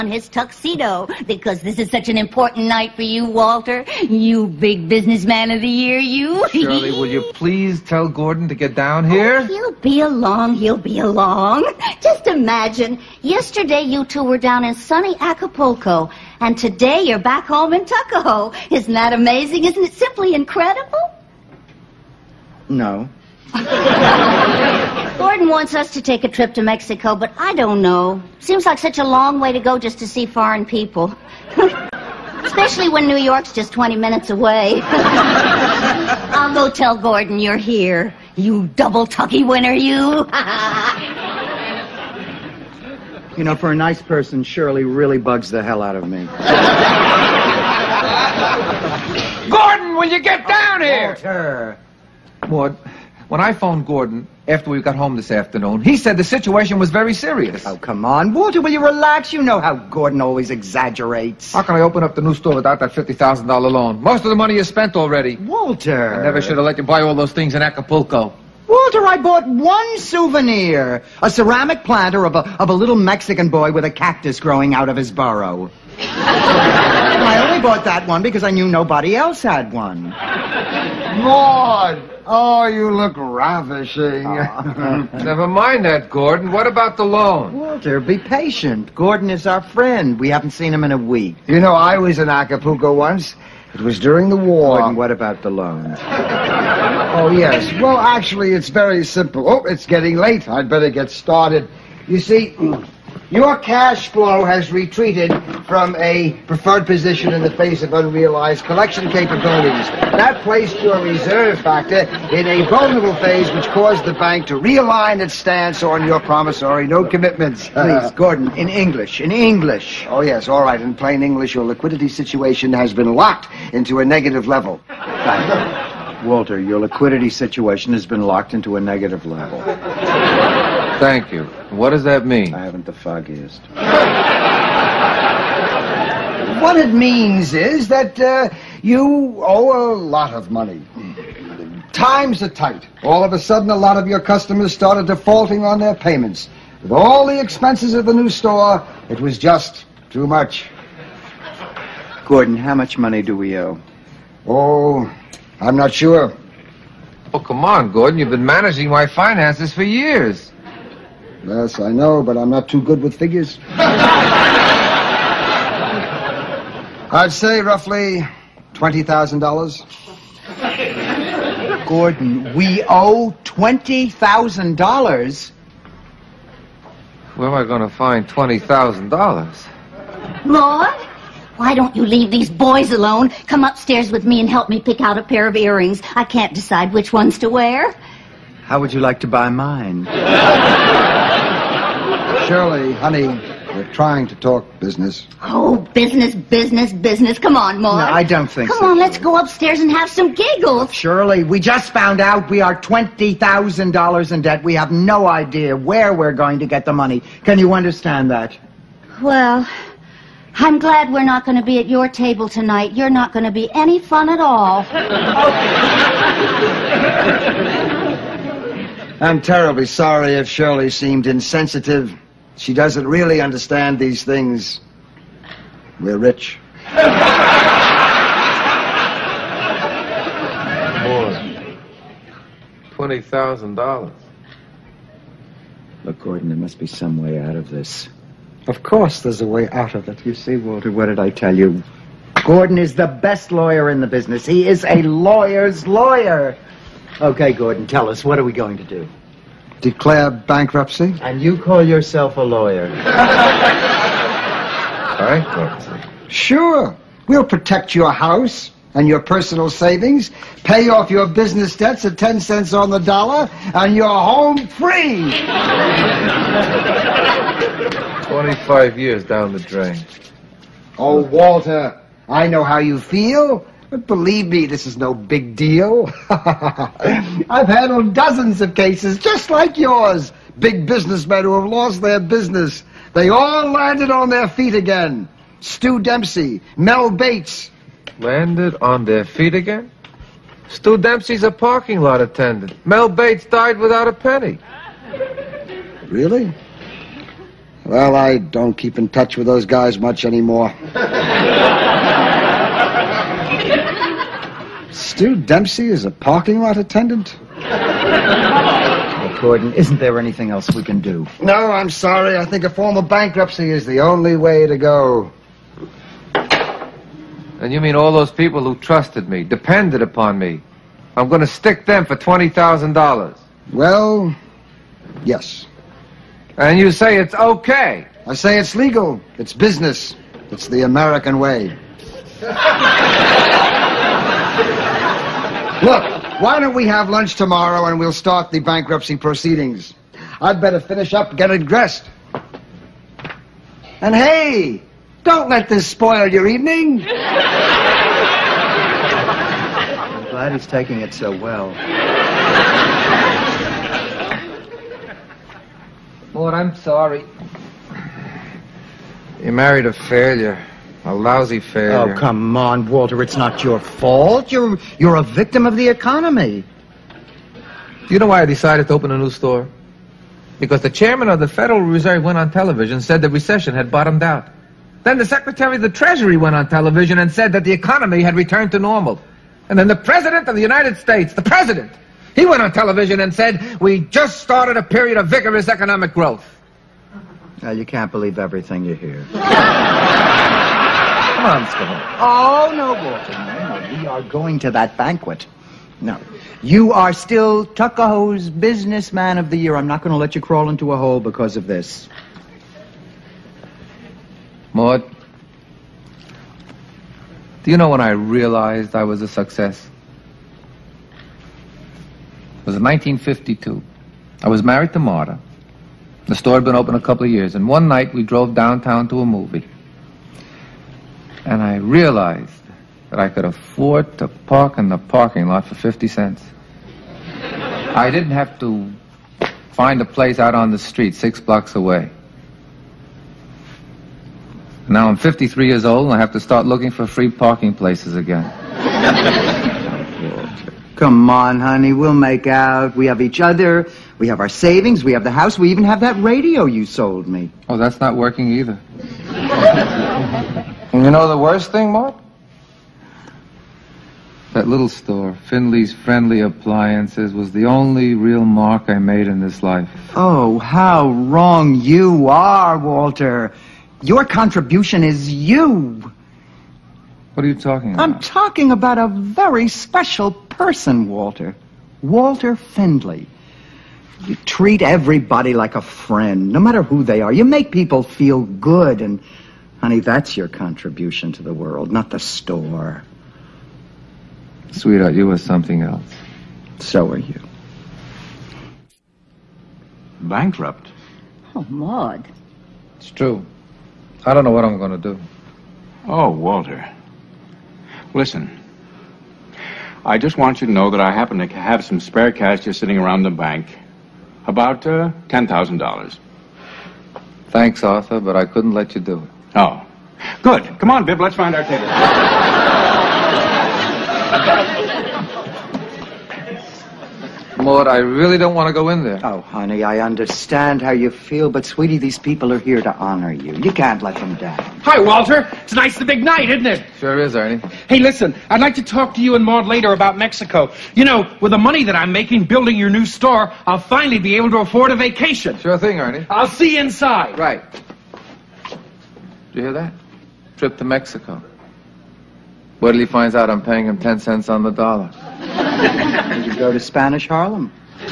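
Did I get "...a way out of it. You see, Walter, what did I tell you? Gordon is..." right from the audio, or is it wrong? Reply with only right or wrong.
right.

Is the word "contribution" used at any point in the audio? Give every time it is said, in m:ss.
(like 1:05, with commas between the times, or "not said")
7:44, 8:00.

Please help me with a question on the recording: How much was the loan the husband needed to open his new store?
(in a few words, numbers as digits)
$50,000.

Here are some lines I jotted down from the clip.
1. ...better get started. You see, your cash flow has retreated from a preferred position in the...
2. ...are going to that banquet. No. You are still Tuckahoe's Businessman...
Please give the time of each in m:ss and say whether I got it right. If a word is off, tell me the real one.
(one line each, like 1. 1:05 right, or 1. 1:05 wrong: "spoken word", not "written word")
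1. 1:40 right
2. 6:34 right.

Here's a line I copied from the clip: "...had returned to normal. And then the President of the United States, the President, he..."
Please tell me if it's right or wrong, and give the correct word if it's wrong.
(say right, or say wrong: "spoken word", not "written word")
right.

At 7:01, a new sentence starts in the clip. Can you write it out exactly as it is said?
And I realized that I could afford to park in the parking lot for 50 cents.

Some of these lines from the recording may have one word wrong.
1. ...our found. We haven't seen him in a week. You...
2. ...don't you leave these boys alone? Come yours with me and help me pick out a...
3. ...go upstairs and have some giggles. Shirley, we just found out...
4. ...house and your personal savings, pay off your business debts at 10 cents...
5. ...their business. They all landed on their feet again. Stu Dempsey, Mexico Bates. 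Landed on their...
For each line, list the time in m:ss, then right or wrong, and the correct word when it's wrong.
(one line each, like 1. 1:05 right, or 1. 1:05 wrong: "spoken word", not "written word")
1. 1:29 wrong: "friend", not "found"
2. 3:01 wrong: "upstairs", not "yours"
3. 3:19 right
4. 4:18 right
5. 4:42 wrong: "Mel", not "Mexico".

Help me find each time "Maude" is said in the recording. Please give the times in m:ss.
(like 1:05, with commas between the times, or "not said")
1:21, 6:44, 8:11, 8:37, 8:49.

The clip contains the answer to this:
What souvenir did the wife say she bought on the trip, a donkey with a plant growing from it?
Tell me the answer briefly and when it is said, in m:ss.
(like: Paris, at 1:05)
ceramic planter, at 1:11.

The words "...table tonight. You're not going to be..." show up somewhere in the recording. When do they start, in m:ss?
3:32.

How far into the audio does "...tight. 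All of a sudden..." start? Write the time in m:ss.
2:22.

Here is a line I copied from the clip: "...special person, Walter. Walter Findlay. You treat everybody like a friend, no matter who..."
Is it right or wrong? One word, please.
right.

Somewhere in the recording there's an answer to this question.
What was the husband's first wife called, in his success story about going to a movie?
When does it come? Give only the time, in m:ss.
6:54.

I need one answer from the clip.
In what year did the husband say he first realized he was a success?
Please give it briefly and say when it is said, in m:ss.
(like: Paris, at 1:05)
1952, at 6:52.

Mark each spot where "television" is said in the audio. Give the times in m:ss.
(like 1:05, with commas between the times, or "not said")
6:12, 6:16, 6:22.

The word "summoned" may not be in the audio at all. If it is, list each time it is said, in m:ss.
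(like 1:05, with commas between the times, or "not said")
not said.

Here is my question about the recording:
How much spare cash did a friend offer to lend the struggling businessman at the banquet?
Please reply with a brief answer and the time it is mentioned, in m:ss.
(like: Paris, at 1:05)
$10,000, at 8:25.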